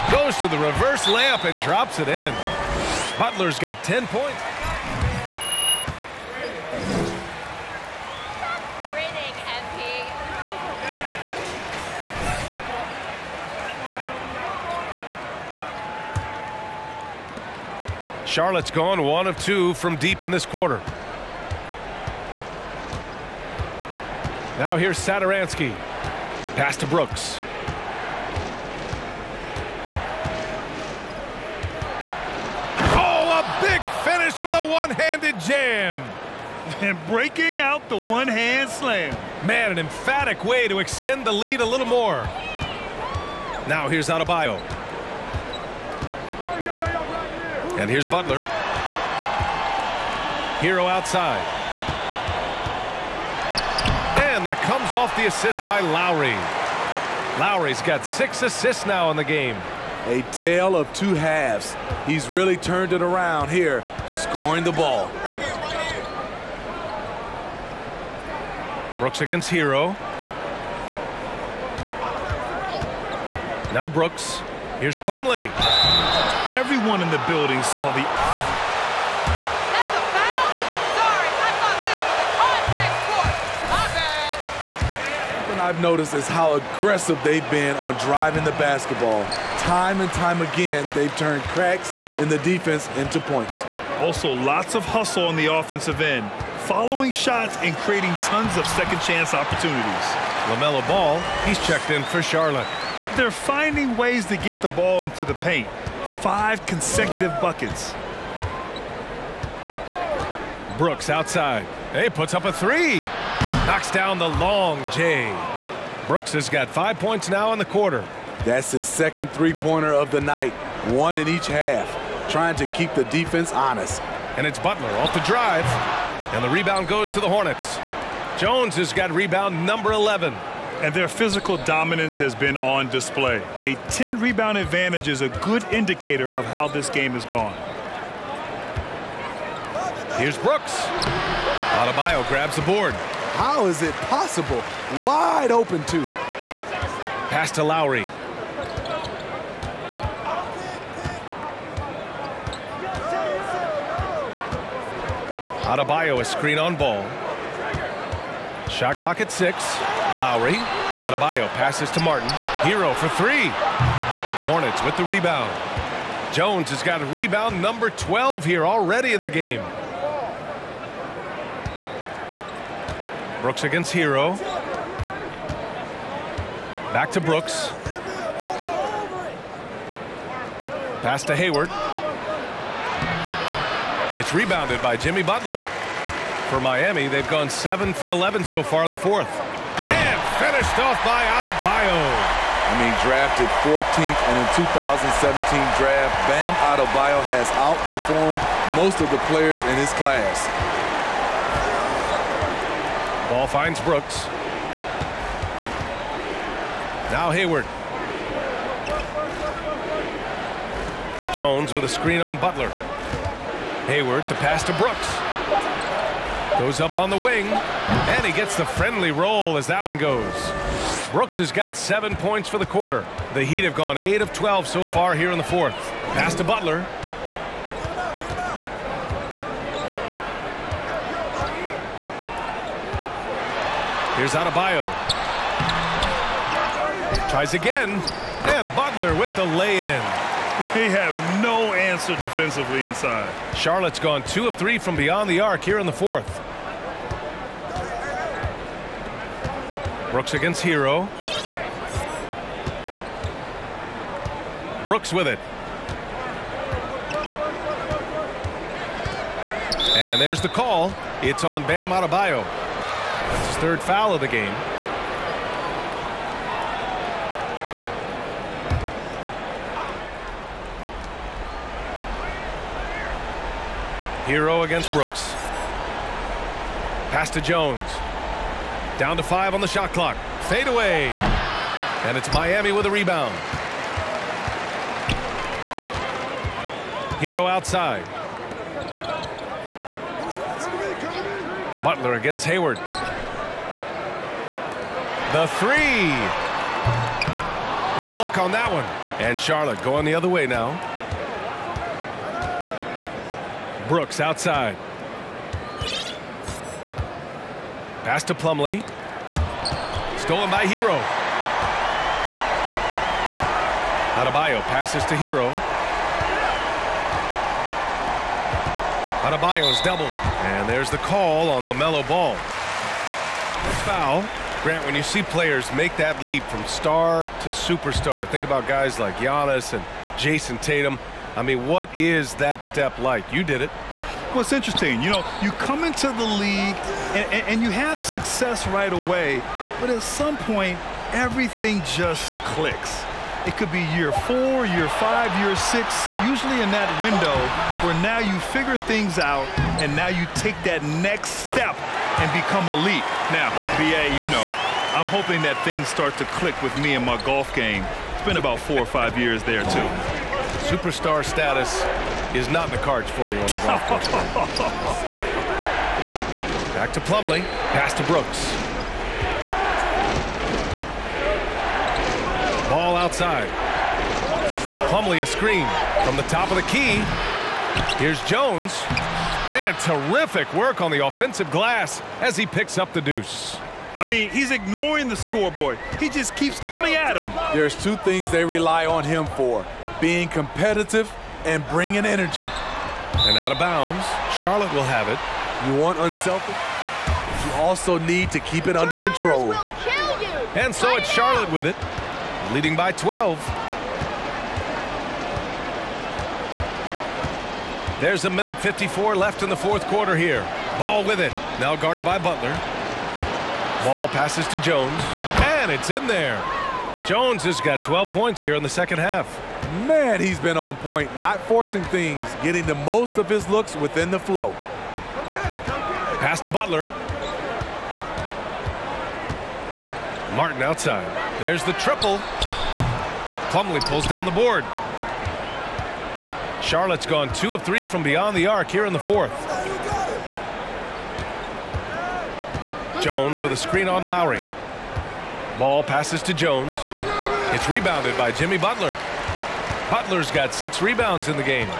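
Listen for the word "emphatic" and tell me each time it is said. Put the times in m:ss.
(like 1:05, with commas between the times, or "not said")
0:39.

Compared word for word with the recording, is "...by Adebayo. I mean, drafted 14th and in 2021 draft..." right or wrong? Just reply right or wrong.
wrong.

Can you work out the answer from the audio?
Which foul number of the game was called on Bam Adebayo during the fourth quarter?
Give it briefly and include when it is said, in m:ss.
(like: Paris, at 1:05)
Third, at 4:23.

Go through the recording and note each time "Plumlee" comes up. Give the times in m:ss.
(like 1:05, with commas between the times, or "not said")
1:14, 5:08, 6:07, 6:14, 7:13.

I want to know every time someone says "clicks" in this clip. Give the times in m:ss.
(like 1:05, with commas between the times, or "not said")
5:42, 5:56.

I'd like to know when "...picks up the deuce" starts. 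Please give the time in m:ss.
6:22.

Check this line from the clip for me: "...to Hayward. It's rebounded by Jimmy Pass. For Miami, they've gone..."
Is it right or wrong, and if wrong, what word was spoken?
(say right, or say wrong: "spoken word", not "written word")
wrong: "Butler", not "Pass".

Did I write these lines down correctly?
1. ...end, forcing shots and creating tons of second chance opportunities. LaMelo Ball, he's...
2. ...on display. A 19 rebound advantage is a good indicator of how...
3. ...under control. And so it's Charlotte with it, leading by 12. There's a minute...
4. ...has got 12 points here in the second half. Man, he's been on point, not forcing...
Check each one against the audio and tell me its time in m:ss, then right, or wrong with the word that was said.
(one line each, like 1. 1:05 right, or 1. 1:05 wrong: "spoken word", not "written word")
1. 1:36 wrong: "following", not "forcing"
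2. 2:12 wrong: "10", not "19"
3. 6:38 right
4. 6:57 right.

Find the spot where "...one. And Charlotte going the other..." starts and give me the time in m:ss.
4:58.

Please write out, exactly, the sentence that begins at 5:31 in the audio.
I mean, what is that step like?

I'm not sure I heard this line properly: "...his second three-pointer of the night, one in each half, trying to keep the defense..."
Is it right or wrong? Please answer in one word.
right.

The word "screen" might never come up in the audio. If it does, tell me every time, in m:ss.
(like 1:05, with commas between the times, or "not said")
2:36, 3:31, 6:15, 7:23.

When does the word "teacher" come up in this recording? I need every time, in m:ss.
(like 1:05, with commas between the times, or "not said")
not said.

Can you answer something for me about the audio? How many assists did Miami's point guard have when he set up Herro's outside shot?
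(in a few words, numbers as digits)
6.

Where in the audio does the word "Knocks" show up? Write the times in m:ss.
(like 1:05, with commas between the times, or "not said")
1:53.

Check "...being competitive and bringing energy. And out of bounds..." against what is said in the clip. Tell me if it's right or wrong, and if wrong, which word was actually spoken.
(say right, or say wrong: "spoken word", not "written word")
right.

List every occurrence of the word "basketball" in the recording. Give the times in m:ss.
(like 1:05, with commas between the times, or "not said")
1:28.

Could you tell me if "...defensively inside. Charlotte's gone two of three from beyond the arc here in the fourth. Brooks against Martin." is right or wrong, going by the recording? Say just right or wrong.
wrong.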